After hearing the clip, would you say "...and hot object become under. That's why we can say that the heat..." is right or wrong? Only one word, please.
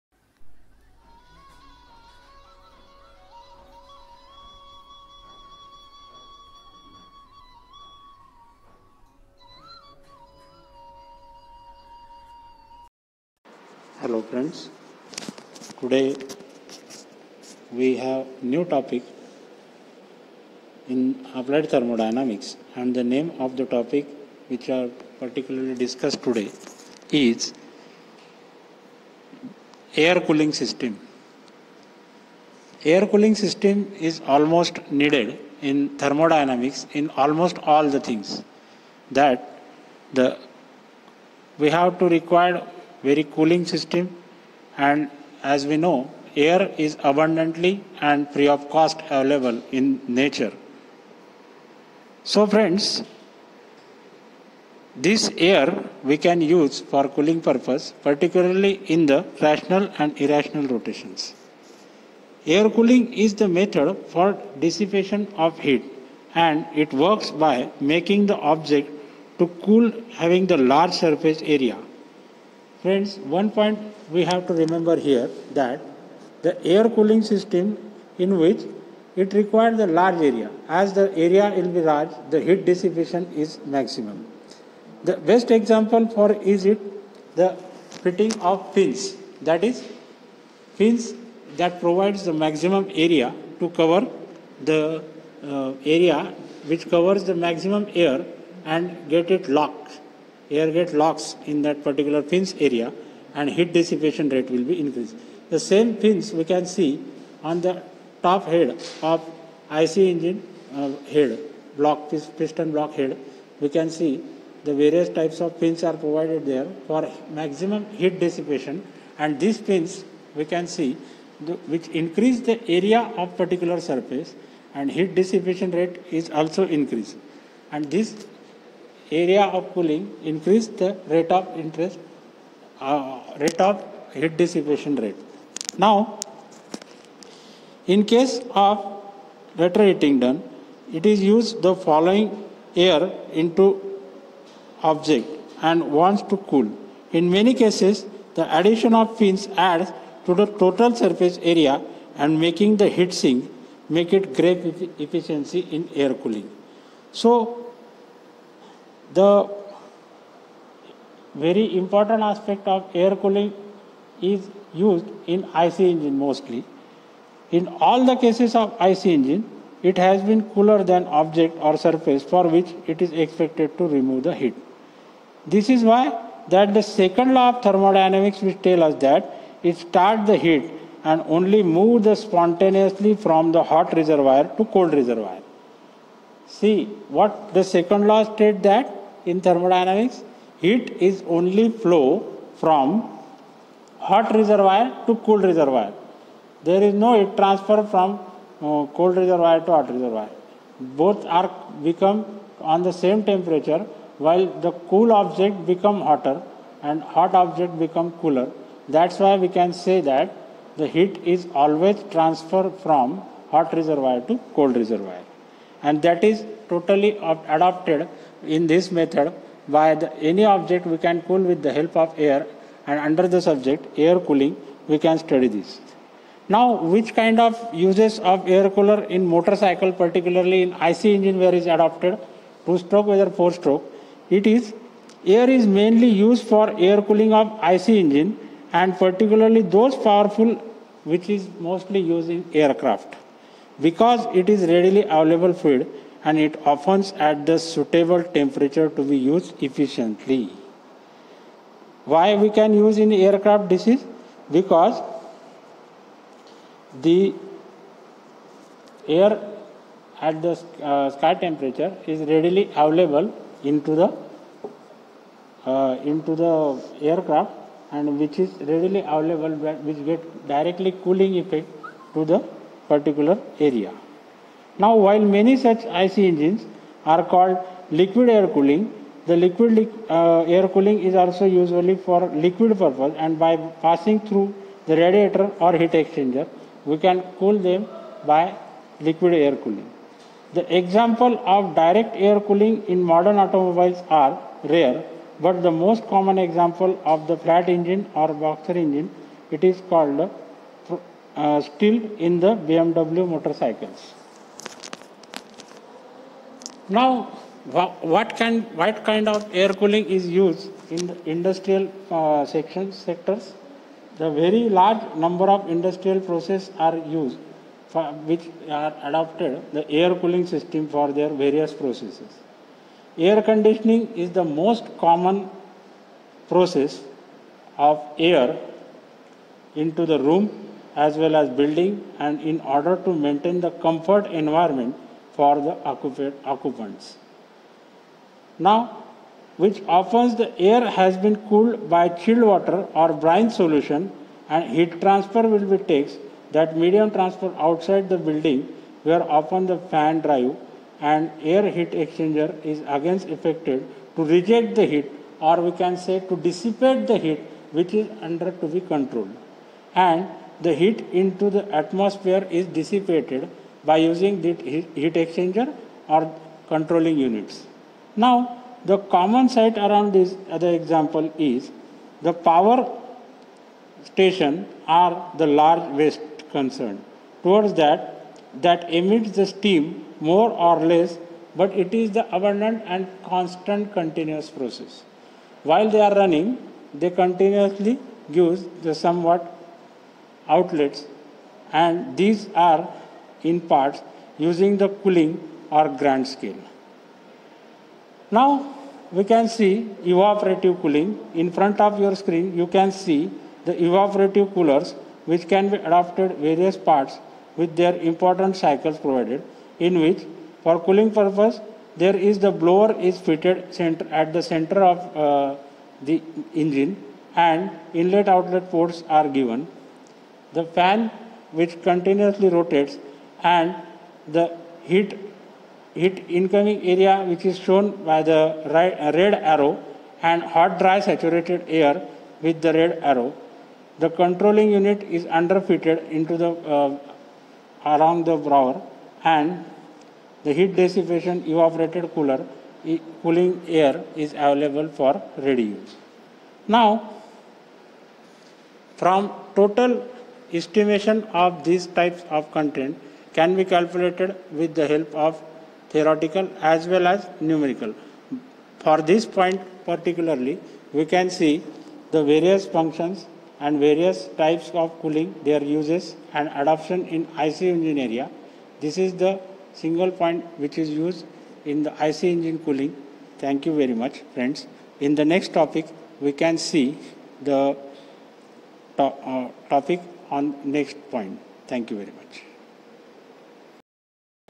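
wrong.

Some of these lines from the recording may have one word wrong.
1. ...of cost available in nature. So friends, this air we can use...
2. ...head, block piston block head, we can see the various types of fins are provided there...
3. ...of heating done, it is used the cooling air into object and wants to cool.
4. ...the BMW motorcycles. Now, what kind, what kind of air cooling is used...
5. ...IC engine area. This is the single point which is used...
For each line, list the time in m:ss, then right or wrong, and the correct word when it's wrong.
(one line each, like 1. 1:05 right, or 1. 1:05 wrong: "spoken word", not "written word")
1. 0:48 right
2. 1:51 right
3. 2:18 wrong: "following", not "cooling"
4. 5:02 right
5. 7:47 right.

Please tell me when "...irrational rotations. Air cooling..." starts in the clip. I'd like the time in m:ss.
1:00.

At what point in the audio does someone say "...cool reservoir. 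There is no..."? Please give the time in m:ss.
3:15.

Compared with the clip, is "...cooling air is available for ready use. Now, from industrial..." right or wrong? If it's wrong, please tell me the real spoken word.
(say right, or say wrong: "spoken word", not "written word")
wrong: "total", not "industrial".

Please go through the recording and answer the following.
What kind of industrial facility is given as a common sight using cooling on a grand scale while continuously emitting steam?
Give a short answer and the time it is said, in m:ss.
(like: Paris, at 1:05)
Power station, at 6:12.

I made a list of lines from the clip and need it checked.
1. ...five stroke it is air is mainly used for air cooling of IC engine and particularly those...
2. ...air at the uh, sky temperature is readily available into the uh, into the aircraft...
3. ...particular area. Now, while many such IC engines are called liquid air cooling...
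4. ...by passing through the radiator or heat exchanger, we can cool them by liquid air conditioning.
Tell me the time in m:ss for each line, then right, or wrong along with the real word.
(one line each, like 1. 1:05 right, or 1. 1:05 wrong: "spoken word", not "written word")
1. 3:53 wrong: "four", not "five"
2. 4:19 right
3. 4:32 right
4. 4:43 wrong: "cooling", not "conditioning".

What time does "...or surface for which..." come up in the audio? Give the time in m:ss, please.
2:51.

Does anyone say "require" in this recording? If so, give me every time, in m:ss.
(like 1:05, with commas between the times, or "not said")
0:42, 1:19.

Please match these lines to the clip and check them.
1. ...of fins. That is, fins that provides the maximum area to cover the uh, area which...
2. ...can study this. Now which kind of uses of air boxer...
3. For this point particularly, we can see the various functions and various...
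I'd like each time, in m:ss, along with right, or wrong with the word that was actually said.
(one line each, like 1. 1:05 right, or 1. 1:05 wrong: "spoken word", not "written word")
1. 1:28 right
2. 3:44 wrong: "cooler", not "boxer"
3. 7:38 right.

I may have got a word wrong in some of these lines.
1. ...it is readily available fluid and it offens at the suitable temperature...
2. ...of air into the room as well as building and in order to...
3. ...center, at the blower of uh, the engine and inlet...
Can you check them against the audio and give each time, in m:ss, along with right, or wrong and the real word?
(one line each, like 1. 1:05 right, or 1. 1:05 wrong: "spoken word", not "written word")
1. 4:04 right
2. 5:27 right
3. 6:53 wrong: "center", not "blower".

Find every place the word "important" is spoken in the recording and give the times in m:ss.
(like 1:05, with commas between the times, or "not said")
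2:41, 6:47.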